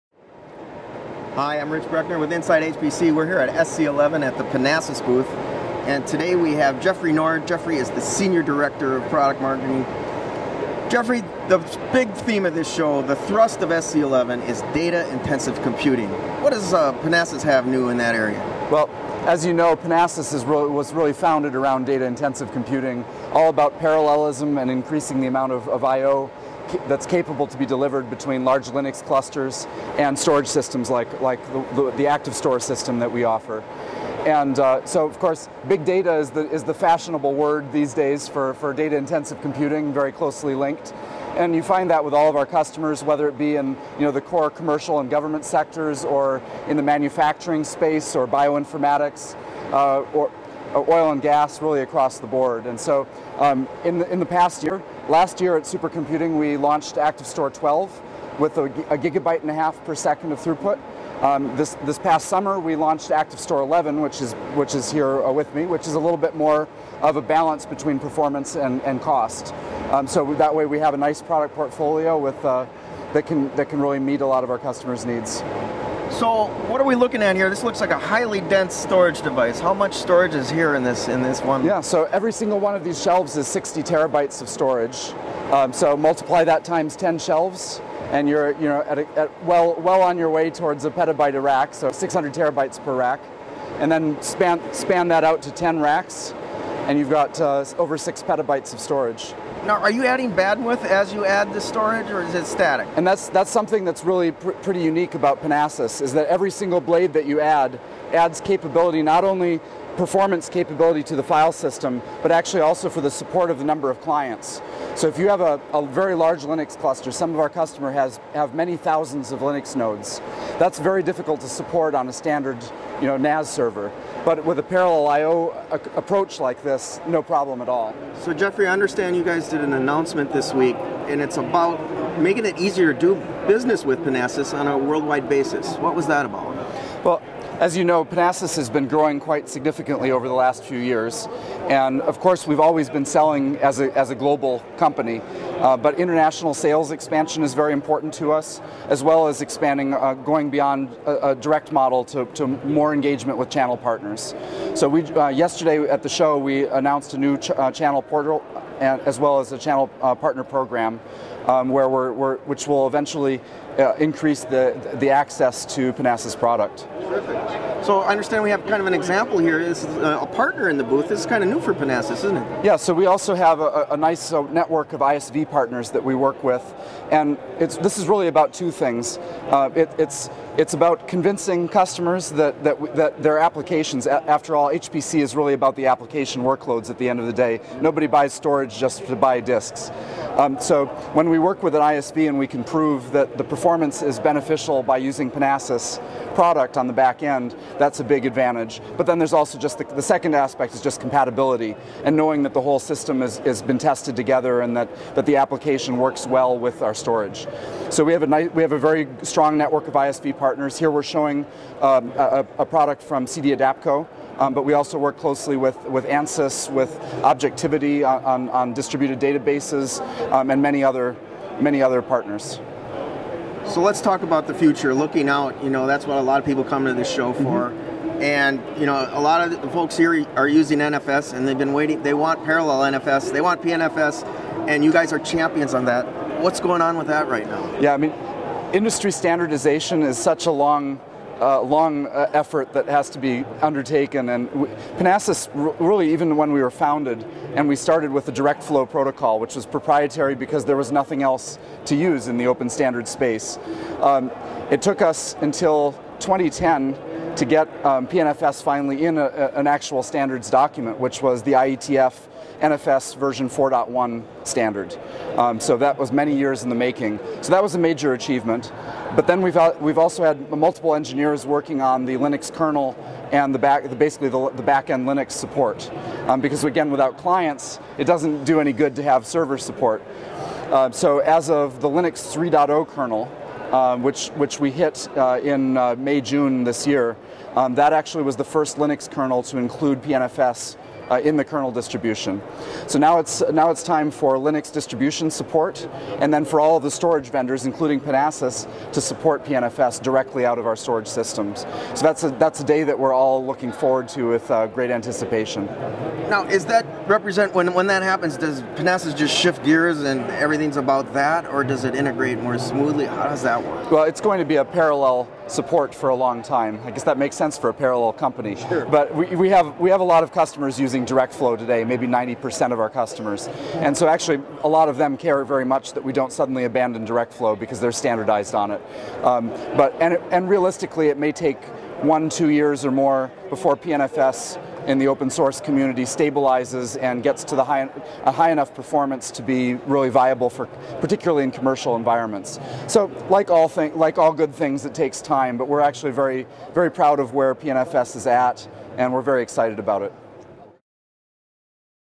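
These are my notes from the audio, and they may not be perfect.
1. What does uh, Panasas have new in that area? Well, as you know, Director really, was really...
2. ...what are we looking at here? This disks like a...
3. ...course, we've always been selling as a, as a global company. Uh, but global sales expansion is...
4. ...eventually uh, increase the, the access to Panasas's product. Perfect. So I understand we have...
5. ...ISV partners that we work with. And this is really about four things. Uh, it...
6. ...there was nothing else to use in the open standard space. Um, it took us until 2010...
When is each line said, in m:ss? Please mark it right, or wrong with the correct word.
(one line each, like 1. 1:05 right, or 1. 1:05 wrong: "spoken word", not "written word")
1. 0:16 wrong: "Panasas", not "Director"
2. 1:16 wrong: "looks", not "disks"
3. 2:22 wrong: "international", not "global"
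4. 2:42 right
5. 2:55 wrong: "two", not "four"
6. 4:10 right.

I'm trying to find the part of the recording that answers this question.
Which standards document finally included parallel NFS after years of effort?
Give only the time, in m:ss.
4:21.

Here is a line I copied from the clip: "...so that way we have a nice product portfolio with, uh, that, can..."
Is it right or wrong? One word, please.
right.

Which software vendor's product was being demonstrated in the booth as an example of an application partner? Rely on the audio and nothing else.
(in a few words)
CD-adapco.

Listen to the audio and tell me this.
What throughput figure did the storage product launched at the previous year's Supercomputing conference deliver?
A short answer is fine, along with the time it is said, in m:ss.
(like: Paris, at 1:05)
1.5 gigabytes per second, at 0:58.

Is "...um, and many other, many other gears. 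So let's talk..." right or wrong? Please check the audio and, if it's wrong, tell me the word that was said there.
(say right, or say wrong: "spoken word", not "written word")
wrong: "partners", not "gears".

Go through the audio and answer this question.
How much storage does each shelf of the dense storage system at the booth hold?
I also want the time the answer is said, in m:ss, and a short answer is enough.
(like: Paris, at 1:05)
60 terabytes, at 1:23.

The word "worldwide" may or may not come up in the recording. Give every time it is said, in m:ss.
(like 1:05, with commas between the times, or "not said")
2:14.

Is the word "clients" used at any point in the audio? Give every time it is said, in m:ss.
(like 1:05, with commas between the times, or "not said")
1:54, 4:37.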